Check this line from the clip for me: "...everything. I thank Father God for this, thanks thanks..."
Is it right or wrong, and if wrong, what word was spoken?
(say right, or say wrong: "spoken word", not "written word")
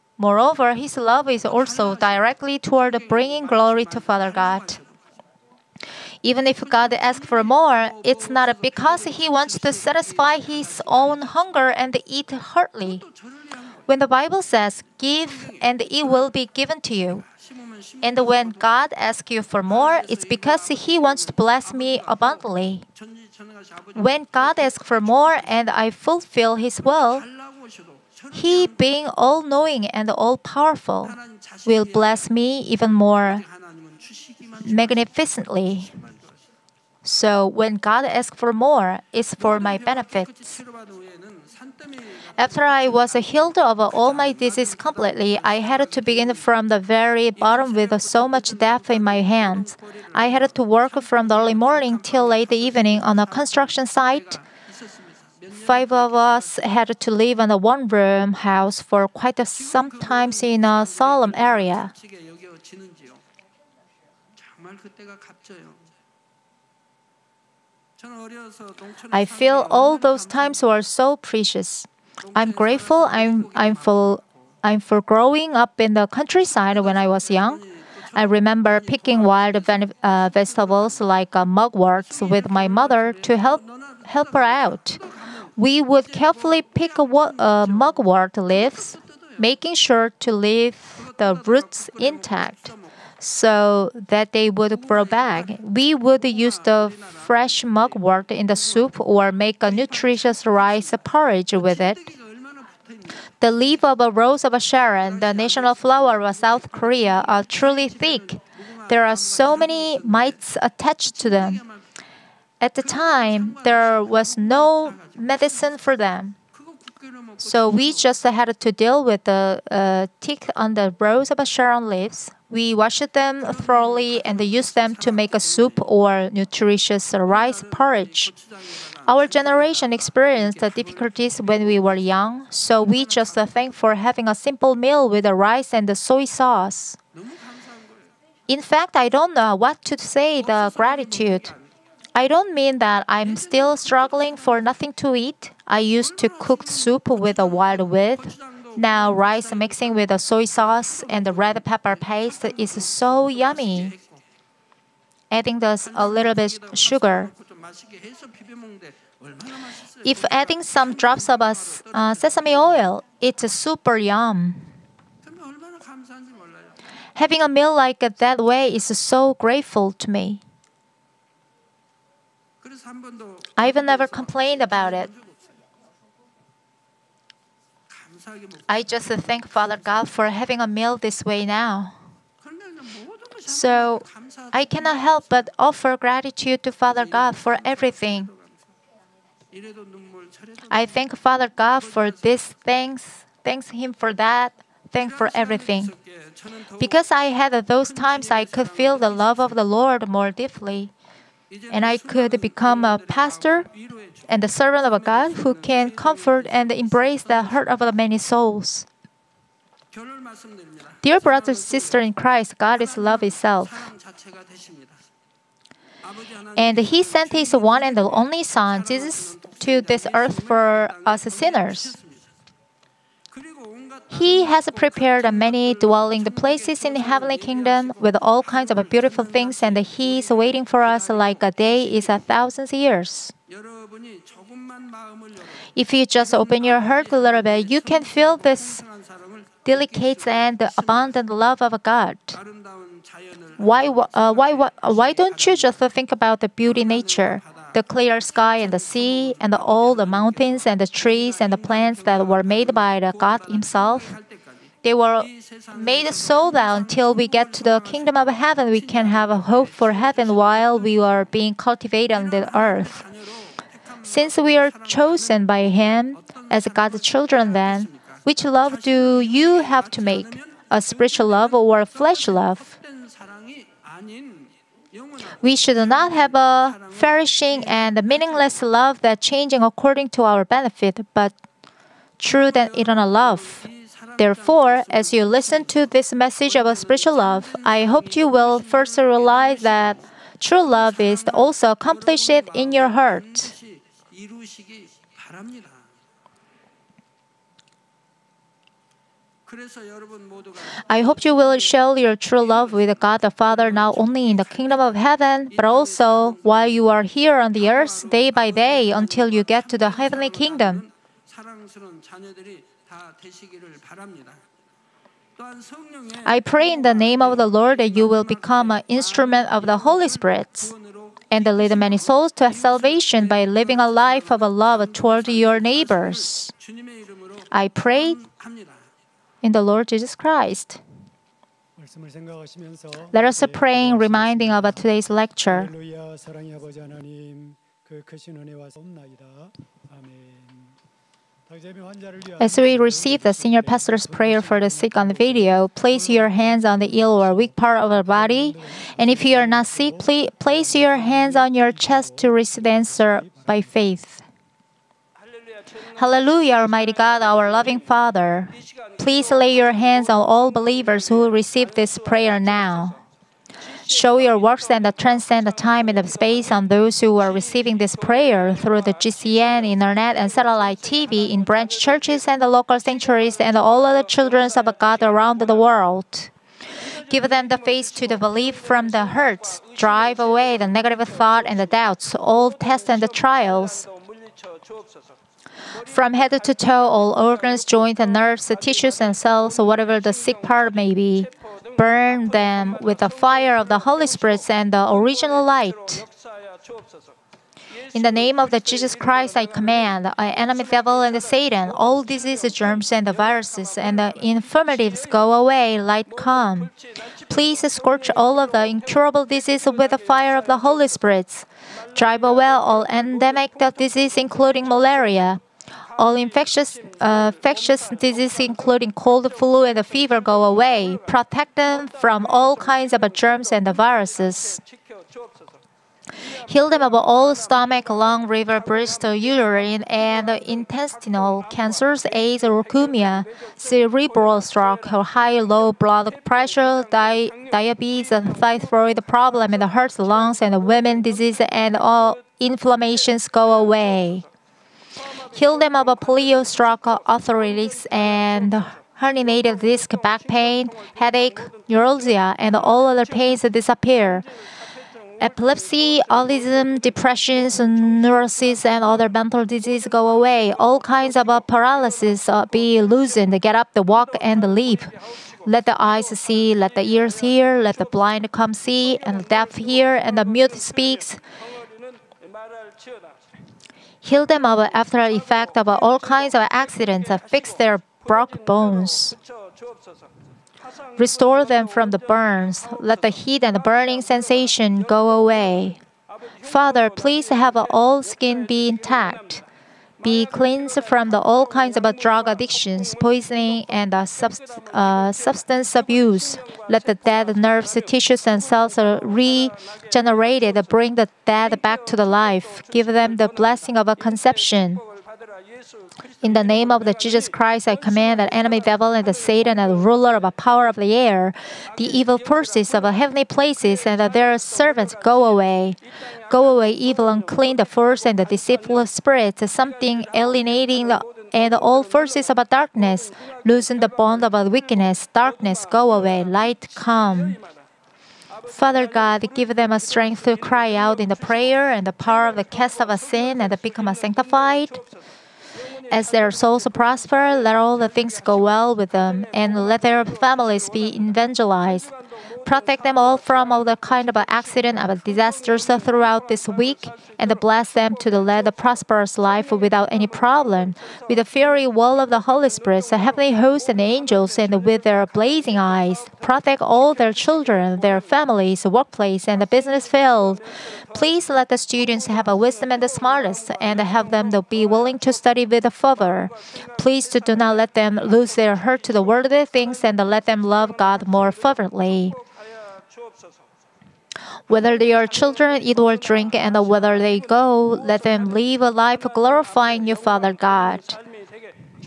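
right.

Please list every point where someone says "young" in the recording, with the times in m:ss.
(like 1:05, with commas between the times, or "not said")
1:17, 2:11.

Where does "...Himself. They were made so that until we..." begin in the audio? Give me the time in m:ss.
4:13.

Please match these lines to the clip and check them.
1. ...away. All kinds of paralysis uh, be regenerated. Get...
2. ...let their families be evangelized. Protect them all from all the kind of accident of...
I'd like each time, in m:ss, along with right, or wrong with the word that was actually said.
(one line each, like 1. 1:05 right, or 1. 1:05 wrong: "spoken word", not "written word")
1. 7:40 wrong: "loosened", not "regenerated"
2. 8:59 right.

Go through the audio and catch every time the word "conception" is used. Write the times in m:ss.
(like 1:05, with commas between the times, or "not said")
8:23.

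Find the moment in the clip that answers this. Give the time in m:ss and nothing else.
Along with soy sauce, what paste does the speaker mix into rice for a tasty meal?
2:31.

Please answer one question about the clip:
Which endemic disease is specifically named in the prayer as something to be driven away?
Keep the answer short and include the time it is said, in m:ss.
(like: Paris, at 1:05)
Malaria, at 6:54.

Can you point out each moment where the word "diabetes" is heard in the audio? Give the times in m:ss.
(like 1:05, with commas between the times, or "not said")
7:17.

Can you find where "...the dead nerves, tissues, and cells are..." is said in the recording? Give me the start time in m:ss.
8:16.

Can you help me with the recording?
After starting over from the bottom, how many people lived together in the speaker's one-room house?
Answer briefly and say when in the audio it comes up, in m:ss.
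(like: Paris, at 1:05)
5, at 0:55.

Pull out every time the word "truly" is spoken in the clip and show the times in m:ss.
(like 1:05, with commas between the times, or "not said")
1:47.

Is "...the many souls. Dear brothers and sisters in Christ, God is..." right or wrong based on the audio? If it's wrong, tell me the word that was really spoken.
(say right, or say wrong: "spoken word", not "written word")
right.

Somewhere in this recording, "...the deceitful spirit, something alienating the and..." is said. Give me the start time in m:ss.
8:38.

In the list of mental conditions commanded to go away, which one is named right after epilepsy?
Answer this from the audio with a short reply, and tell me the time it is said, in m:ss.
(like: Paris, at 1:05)
Autism, at 7:36.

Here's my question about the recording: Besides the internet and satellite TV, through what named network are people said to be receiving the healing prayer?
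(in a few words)
GCN.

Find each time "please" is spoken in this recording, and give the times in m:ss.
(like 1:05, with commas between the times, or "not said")
5:49, 5:59, 6:47, 8:06, 9:20, 9:26.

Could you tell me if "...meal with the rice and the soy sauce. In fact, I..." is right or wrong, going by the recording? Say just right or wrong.
right.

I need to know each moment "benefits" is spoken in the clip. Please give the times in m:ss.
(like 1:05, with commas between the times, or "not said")
0:39, 4:40.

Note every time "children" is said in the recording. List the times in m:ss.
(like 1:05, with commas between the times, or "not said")
4:27, 6:14, 9:17, 9:35.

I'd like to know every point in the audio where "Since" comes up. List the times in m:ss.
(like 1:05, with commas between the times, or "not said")
4:24.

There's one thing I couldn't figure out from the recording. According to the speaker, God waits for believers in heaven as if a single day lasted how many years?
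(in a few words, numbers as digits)
1,000.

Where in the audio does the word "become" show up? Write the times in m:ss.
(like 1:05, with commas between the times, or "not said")
3:22, 5:18, 8:53.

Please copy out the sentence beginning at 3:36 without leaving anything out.
And He sent His one and only Son, Jesus, to this earth for us sinners.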